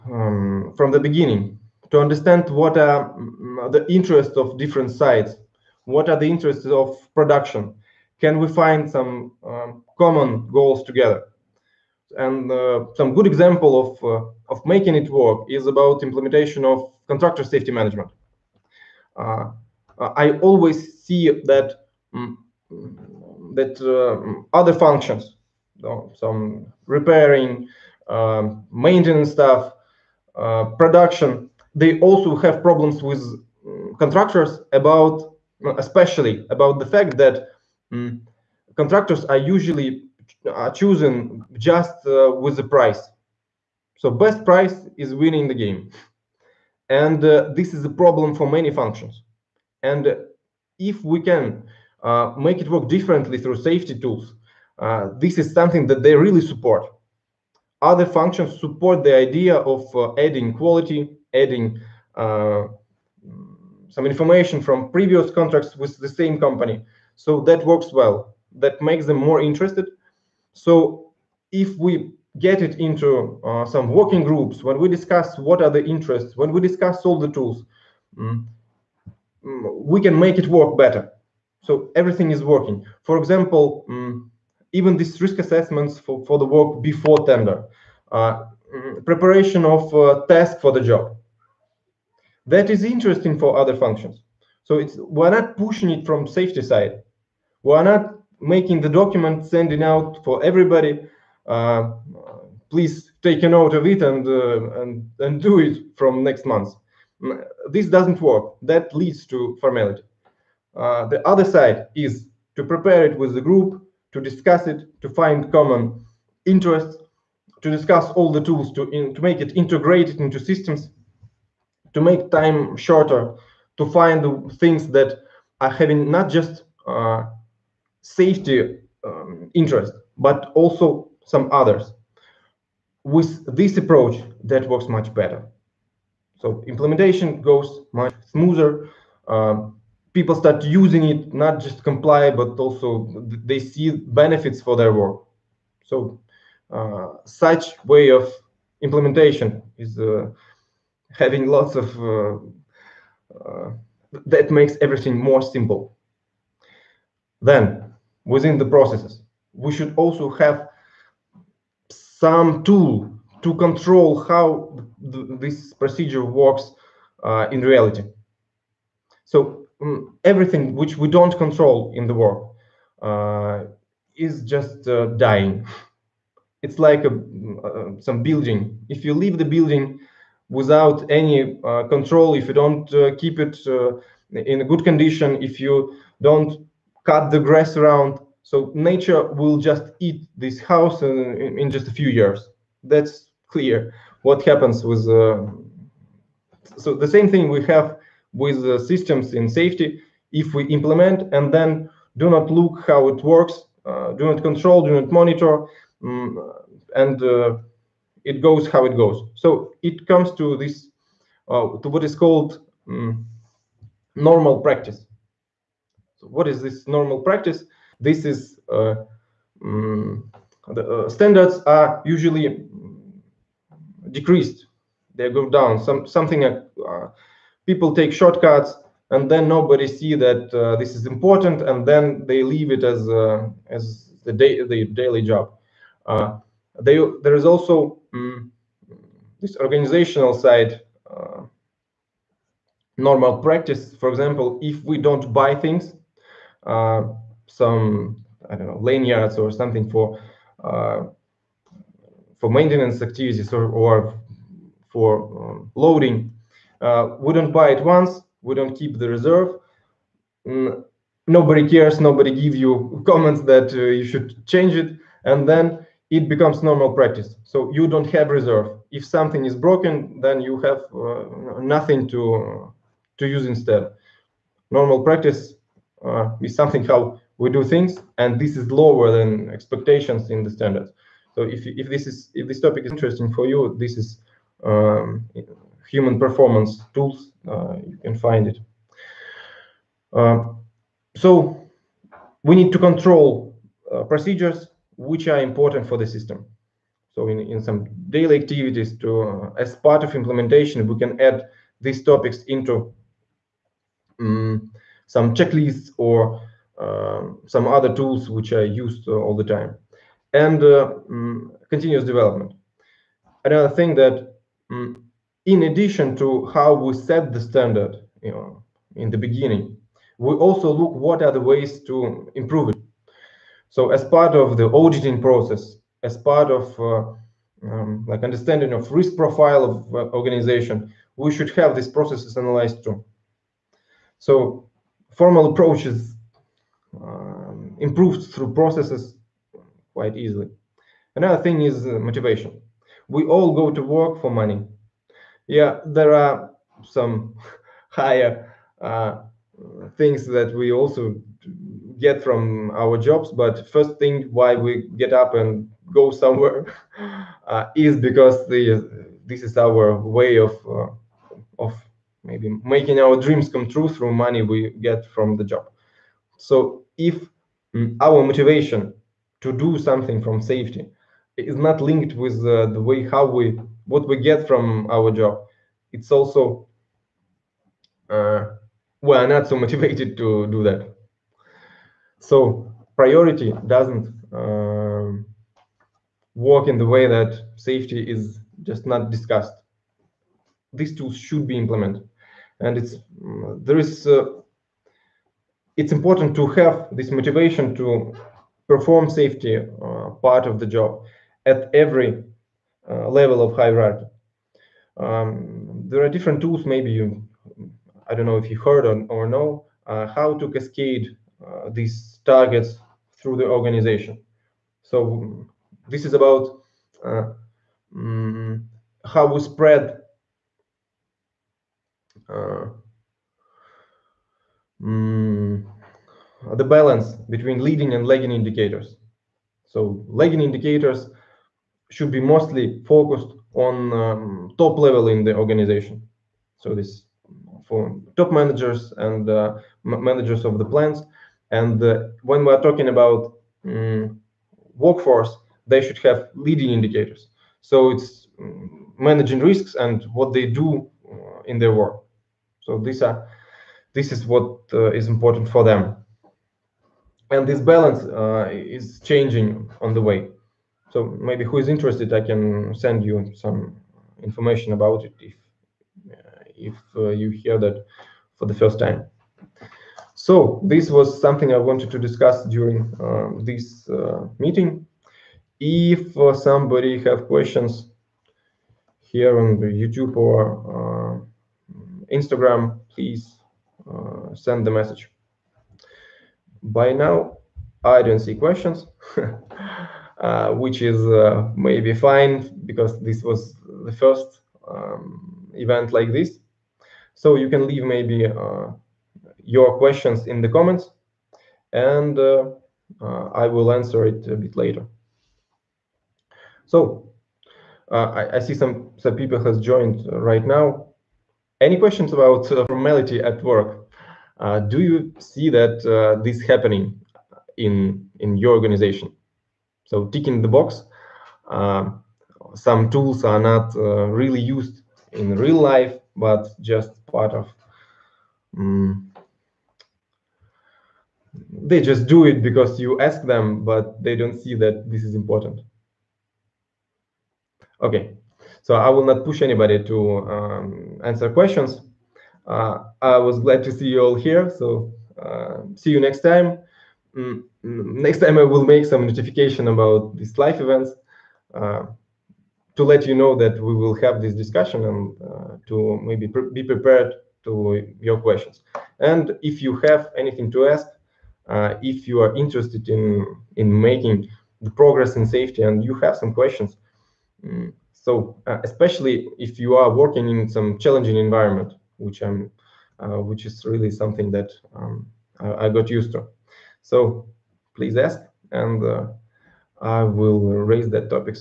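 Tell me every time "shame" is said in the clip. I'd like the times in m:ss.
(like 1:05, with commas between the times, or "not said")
not said.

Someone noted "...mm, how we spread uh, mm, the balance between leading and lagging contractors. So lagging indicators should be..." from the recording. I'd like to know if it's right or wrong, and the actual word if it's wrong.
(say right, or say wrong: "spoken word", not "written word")
wrong: "indicators", not "contractors".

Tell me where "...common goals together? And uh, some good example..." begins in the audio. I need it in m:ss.
0:09.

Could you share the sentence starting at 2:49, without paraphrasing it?
So um, everything which we don't control in the work uh, is just uh, dying.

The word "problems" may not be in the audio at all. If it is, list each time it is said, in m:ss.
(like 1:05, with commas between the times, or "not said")
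0:32, 0:47.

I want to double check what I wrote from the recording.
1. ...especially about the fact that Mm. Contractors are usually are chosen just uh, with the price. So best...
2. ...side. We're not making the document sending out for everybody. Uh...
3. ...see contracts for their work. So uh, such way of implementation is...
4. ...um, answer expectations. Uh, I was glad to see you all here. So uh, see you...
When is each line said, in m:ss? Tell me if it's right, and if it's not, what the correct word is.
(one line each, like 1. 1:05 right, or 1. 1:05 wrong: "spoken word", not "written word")
1. 0:35 right
2. 1:36 right
3. 2:23 wrong: "benefits", not "contracts"
4. 9:00 wrong: "questions", not "expectations".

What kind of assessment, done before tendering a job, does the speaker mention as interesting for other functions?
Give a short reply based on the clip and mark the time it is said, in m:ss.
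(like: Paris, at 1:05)
Risk assessments, at 1:25.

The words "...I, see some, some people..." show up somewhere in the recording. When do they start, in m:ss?
8:28.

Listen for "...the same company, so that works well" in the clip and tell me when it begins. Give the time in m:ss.
1:05.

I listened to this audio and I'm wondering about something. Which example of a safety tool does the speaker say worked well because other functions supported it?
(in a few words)
Contractor safety management.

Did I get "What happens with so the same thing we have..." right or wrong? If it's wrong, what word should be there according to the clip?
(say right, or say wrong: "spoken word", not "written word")
right.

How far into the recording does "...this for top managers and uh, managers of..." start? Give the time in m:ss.
7:16.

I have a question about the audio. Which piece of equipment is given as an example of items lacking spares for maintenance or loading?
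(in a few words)
Lanyards.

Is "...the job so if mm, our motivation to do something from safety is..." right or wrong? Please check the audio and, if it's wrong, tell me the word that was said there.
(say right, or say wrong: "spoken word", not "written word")
right.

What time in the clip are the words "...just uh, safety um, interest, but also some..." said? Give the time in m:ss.
2:06.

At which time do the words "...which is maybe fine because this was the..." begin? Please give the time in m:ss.
8:10.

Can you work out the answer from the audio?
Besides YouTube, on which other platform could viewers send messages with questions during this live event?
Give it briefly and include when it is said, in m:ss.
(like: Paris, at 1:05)
Instagram, at 8:02.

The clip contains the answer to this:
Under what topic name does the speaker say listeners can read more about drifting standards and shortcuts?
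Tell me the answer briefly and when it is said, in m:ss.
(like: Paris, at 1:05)
Human performance tools, at 4:45.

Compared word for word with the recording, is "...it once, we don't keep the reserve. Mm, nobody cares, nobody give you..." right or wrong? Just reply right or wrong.
right.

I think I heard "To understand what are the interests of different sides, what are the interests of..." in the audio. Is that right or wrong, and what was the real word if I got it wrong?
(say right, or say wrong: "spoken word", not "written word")
right.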